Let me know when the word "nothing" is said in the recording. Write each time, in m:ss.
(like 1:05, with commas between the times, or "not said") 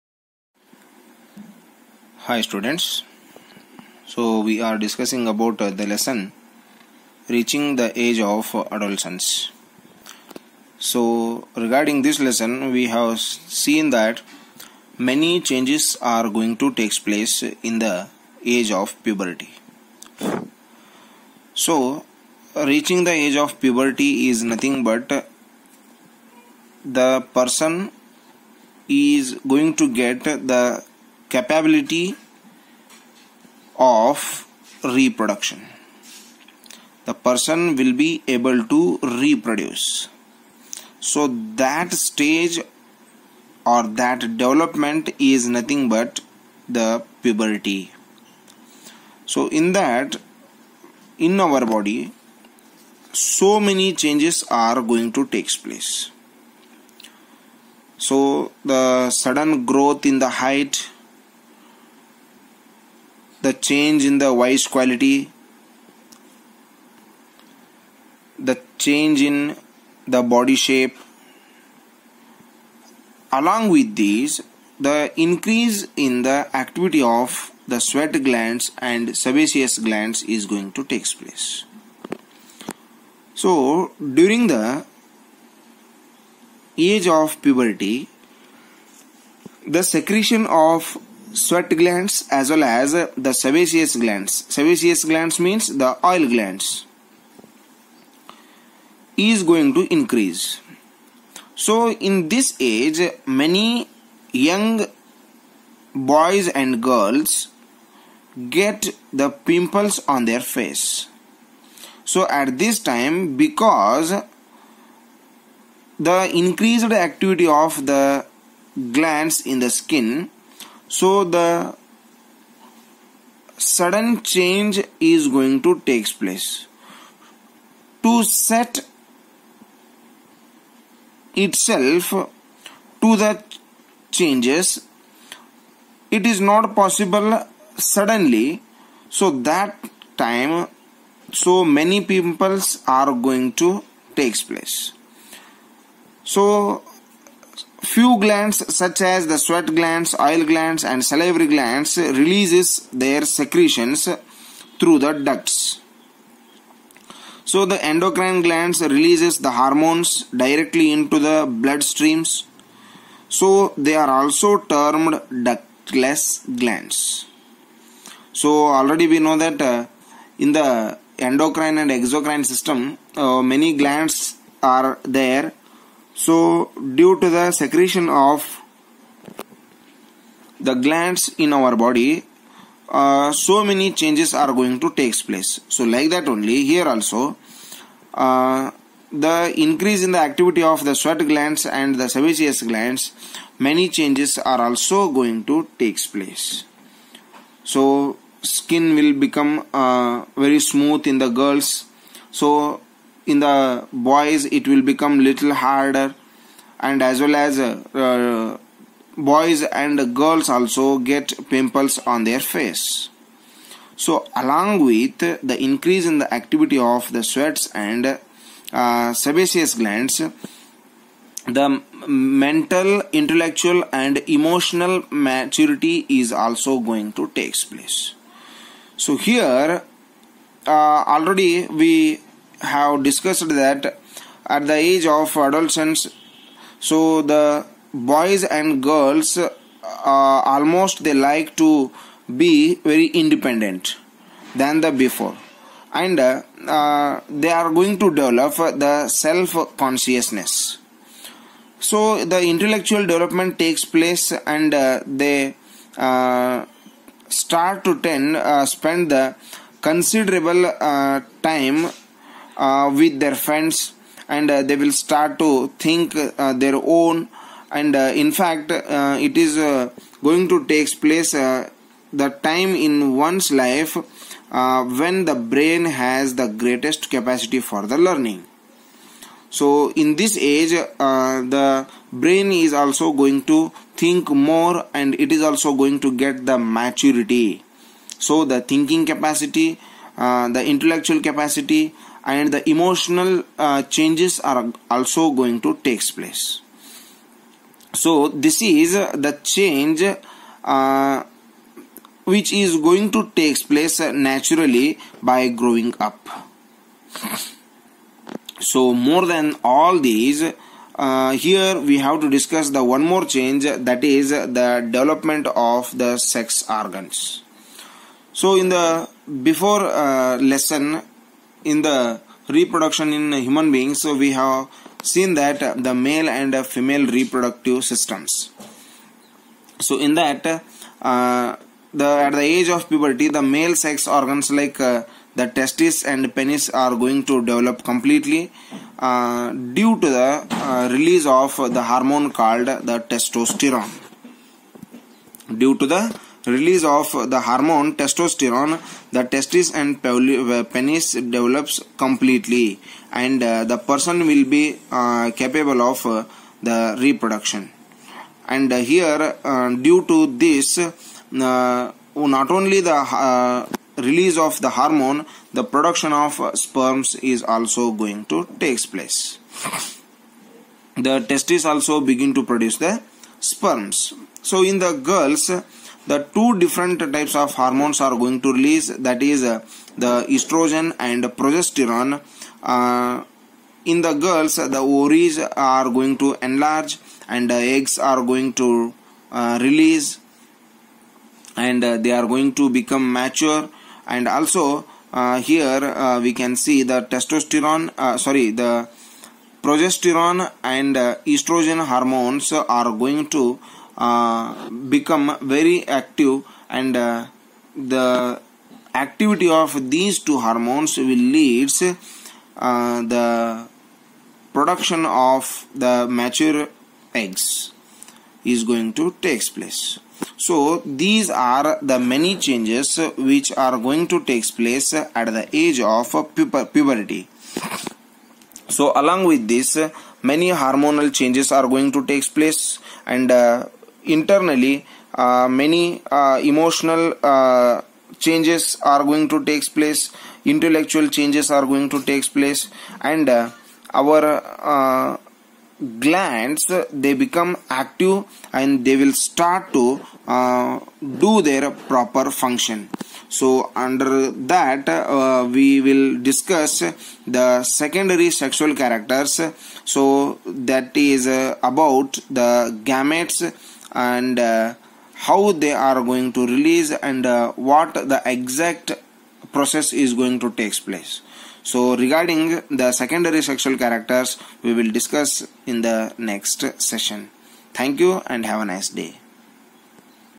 0:24, 0:45.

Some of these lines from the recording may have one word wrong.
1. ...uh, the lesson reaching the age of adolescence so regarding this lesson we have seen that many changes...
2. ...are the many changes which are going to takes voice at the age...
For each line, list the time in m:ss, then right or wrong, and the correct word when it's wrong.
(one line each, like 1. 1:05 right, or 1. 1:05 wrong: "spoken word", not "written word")
1. 0:05 right
2. 7:01 wrong: "place", not "voice".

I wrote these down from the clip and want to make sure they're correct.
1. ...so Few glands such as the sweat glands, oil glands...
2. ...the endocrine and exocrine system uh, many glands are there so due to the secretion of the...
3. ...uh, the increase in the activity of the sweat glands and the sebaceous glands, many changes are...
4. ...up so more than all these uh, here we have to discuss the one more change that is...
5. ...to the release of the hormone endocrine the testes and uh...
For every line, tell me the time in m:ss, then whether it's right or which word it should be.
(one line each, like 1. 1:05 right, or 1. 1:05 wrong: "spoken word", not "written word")
1. 2:26 right
2. 2:50 right
3. 3:08 right
4. 5:05 right
5. 5:45 wrong: "testosterone", not "endocrine".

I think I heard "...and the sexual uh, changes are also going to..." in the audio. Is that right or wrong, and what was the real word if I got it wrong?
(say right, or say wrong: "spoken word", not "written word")
wrong: "emotional", not "sexual".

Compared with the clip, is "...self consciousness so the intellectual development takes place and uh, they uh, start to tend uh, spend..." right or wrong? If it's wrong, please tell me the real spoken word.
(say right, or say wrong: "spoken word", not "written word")
right.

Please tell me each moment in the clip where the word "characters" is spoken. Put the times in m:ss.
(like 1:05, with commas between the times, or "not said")
7:38, 7:53.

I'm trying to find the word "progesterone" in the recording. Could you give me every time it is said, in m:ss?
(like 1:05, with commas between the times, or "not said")
6:21, 6:39.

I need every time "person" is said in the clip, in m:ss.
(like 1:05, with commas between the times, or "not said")
0:27, 0:37, 5:53.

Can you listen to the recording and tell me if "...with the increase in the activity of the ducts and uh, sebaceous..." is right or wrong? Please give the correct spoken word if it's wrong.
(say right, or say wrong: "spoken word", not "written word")
wrong: "sweats", not "ducts".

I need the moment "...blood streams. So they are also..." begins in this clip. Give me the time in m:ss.
2:41.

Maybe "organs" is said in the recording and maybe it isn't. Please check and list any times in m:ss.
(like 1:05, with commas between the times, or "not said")
5:16, 5:34.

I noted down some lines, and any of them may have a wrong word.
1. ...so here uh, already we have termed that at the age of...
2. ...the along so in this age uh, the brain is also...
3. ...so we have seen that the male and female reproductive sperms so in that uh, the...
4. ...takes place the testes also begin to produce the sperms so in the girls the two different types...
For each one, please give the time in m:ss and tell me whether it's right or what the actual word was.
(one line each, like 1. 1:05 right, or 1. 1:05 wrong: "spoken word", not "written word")
1. 3:48 wrong: "discussed", not "termed"
2. 4:37 wrong: "learning", not "along"
3. 5:24 wrong: "systems", not "sperms"
4. 6:08 right.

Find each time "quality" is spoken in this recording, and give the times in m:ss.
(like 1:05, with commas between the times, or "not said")
1:04.